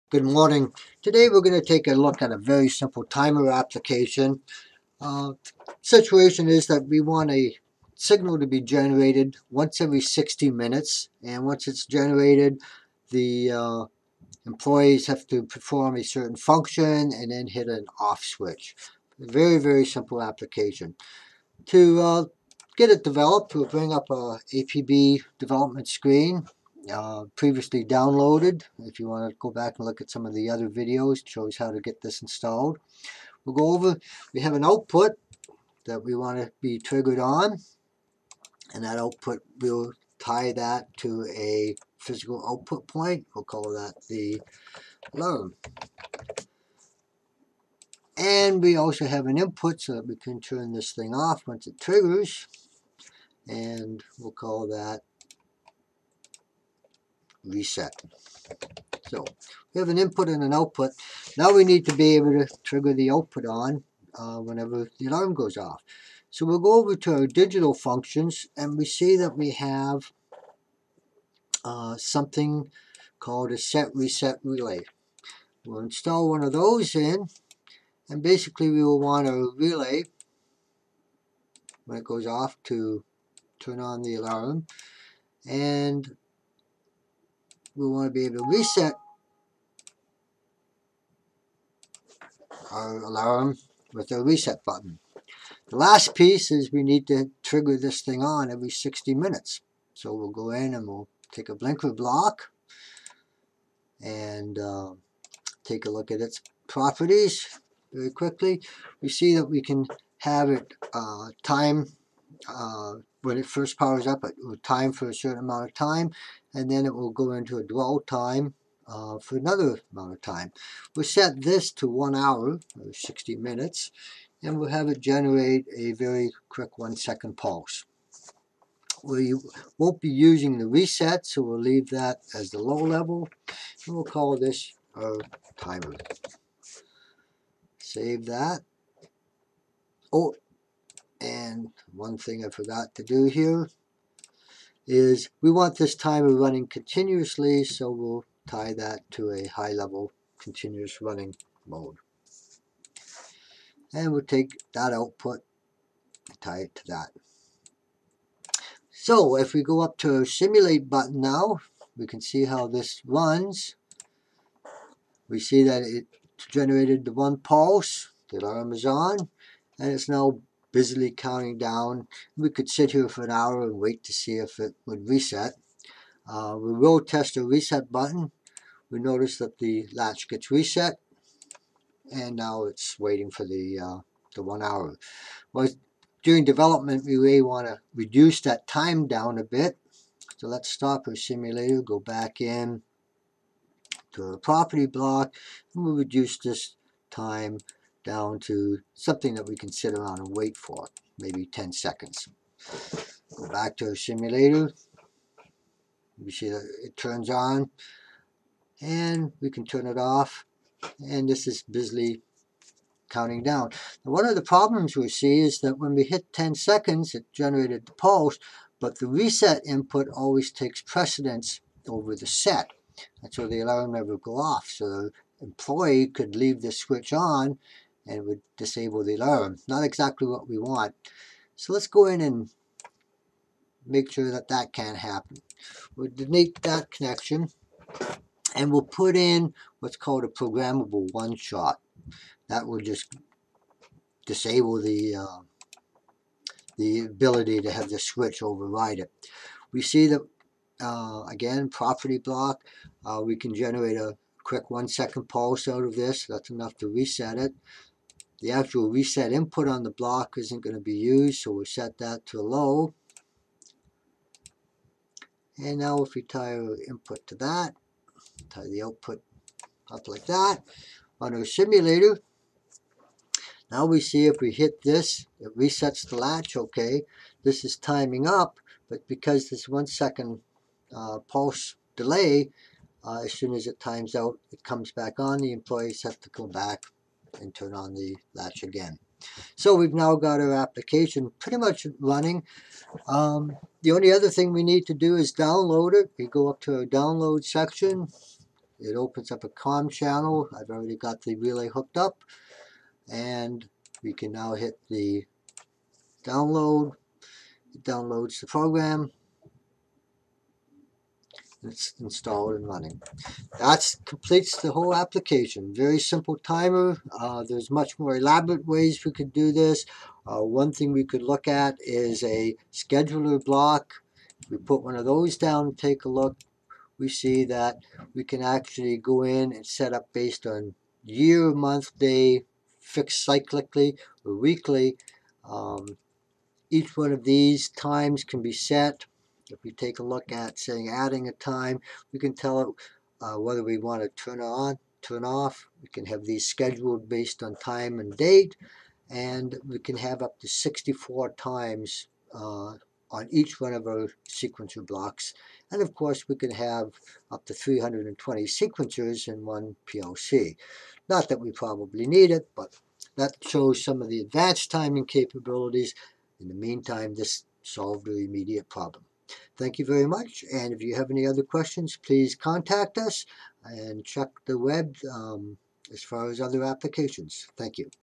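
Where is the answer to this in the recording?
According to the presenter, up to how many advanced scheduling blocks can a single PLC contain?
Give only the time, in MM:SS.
05:57.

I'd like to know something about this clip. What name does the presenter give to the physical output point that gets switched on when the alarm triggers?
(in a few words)
load.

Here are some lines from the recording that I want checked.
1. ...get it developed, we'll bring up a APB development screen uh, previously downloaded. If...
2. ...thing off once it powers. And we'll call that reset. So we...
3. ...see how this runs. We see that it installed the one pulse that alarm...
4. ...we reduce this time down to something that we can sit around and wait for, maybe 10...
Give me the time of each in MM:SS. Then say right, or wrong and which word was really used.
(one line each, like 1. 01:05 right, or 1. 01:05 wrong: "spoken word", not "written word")
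1. 00:22 right
2. 00:50 wrong: "triggers", not "powers"
3. 02:42 wrong: "generated", not "installed"
4. 03:15 right.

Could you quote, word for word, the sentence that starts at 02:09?
We won't be using the reset, so we'll leave that as the low level, and we'll call this our timer.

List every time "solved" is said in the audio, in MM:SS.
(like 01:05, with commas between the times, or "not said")
06:07.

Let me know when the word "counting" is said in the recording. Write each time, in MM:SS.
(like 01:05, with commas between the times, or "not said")
02:51, 03:33.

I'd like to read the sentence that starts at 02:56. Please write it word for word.
Uh, we will test the reset button.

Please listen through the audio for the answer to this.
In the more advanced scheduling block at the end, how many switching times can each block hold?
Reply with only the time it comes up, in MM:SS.
05:50.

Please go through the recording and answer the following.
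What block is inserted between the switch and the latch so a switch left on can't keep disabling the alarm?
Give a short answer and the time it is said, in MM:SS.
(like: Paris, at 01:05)
programmable one-shot, at 04:00.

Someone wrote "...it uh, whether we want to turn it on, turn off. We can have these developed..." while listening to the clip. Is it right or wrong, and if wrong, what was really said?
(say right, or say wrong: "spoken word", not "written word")
wrong: "scheduled", not "developed".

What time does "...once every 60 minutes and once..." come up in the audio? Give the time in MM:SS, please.
00:09.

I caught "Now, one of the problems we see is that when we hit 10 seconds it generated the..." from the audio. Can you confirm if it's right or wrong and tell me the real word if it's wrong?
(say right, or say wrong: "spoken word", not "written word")
right.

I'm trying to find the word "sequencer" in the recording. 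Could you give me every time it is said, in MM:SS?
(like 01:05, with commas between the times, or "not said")
05:54, 05:58.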